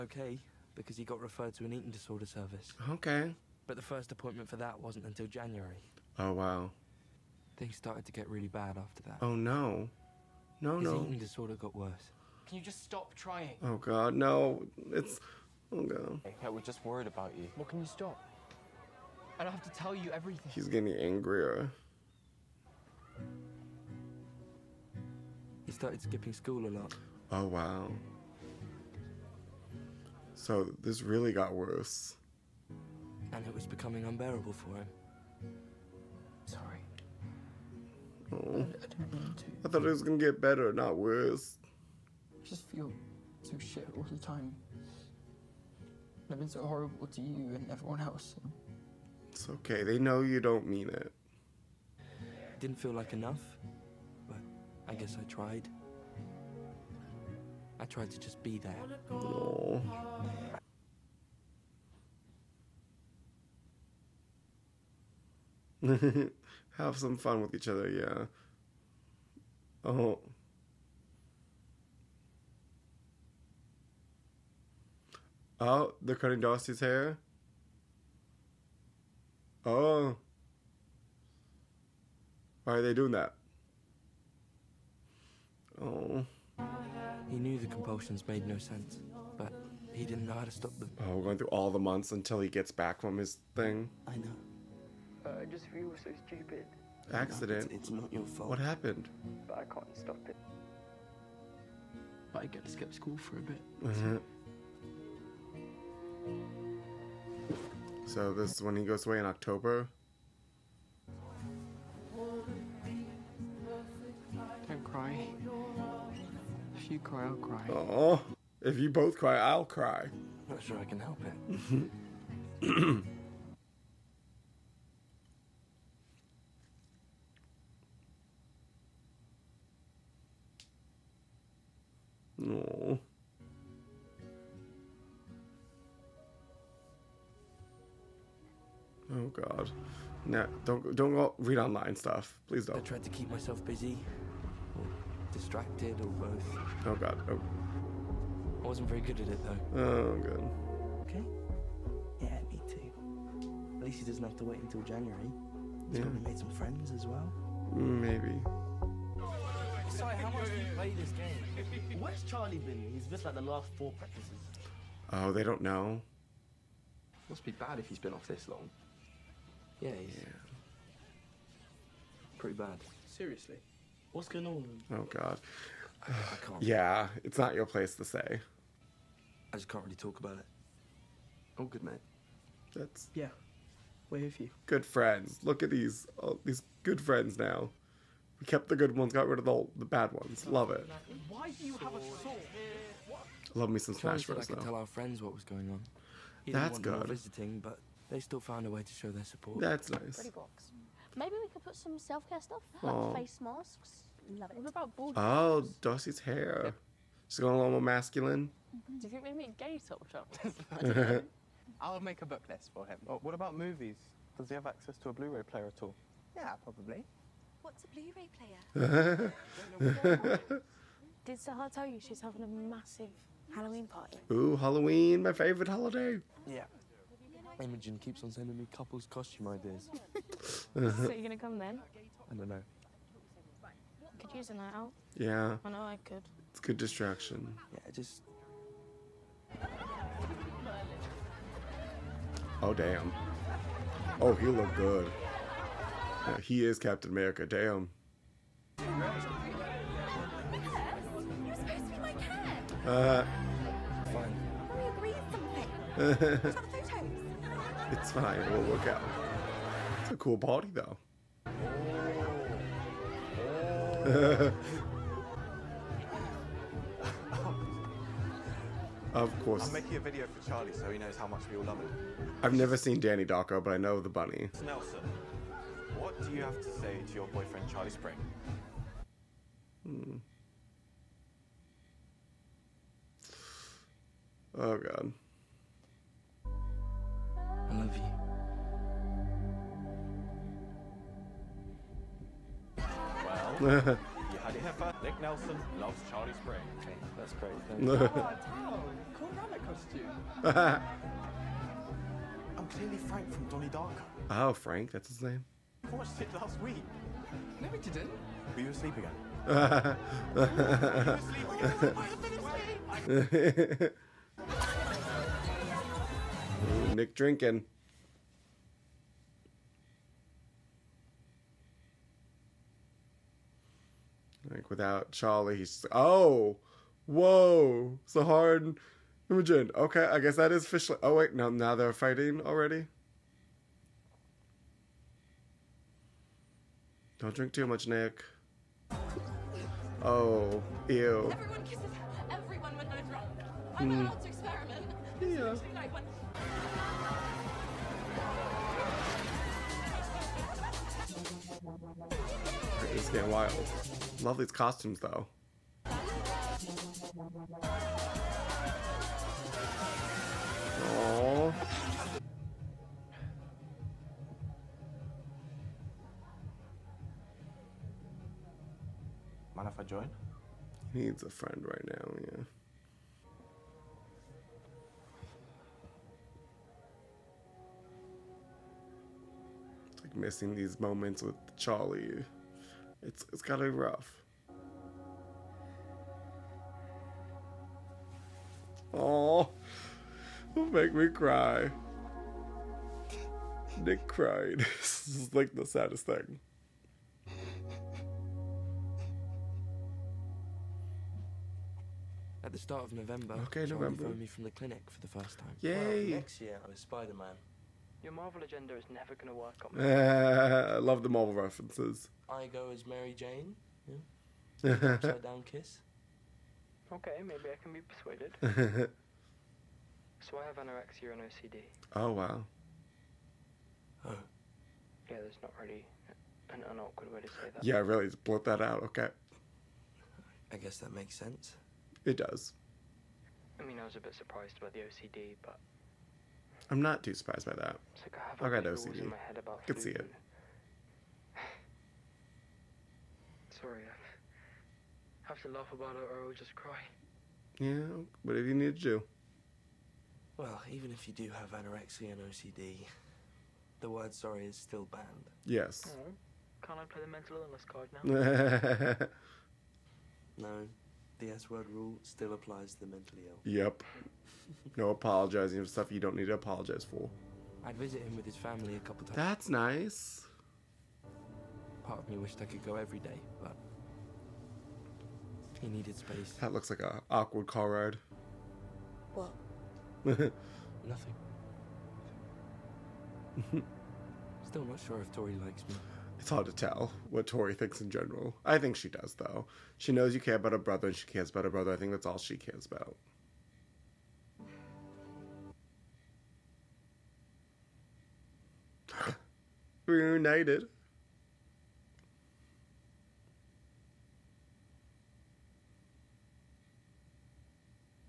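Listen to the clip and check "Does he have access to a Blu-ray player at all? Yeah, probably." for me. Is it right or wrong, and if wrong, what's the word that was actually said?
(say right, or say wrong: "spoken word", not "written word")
right.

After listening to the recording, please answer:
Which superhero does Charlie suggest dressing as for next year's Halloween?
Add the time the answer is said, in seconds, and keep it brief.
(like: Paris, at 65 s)
Spider-Man, at 406 s.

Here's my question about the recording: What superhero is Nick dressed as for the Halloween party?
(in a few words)
Captain America.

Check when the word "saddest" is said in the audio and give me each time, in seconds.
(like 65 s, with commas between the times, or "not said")
395 s.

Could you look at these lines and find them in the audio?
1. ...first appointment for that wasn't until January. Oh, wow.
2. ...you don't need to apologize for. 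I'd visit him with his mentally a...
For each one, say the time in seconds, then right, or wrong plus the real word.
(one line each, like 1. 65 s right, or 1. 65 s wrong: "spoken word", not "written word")
1. 3 s right
2. 465 s wrong: "family", not "mentally".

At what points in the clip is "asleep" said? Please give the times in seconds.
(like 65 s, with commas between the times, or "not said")
308 s.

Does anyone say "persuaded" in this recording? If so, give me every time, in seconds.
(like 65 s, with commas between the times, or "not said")
417 s.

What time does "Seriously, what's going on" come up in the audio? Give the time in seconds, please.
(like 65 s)
173 s.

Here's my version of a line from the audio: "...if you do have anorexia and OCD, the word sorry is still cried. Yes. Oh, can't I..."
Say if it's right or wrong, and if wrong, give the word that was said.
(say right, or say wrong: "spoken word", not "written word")
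wrong: "banned", not "cried".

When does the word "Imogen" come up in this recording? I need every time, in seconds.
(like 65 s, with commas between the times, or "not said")
227 s, 329 s.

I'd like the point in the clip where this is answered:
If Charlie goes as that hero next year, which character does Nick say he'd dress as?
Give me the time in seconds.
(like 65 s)
412 s.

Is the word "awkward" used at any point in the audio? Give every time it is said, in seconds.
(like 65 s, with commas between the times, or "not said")
426 s, 477 s.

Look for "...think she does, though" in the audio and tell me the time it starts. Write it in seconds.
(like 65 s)
488 s.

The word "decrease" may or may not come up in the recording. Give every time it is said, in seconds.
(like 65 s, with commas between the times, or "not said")
not said.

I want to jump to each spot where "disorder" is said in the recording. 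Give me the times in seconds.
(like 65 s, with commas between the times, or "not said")
1 s, 11 s.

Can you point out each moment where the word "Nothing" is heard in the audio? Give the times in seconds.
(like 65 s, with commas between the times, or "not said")
480 s.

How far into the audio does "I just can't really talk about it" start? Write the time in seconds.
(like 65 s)
179 s.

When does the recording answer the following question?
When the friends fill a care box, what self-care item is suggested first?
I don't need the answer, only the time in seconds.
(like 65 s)
203 s.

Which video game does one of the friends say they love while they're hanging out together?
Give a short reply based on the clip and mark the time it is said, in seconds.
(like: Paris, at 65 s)
Smash Bros, at 193 s.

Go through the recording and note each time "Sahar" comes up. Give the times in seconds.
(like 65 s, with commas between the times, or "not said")
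221 s, 328 s.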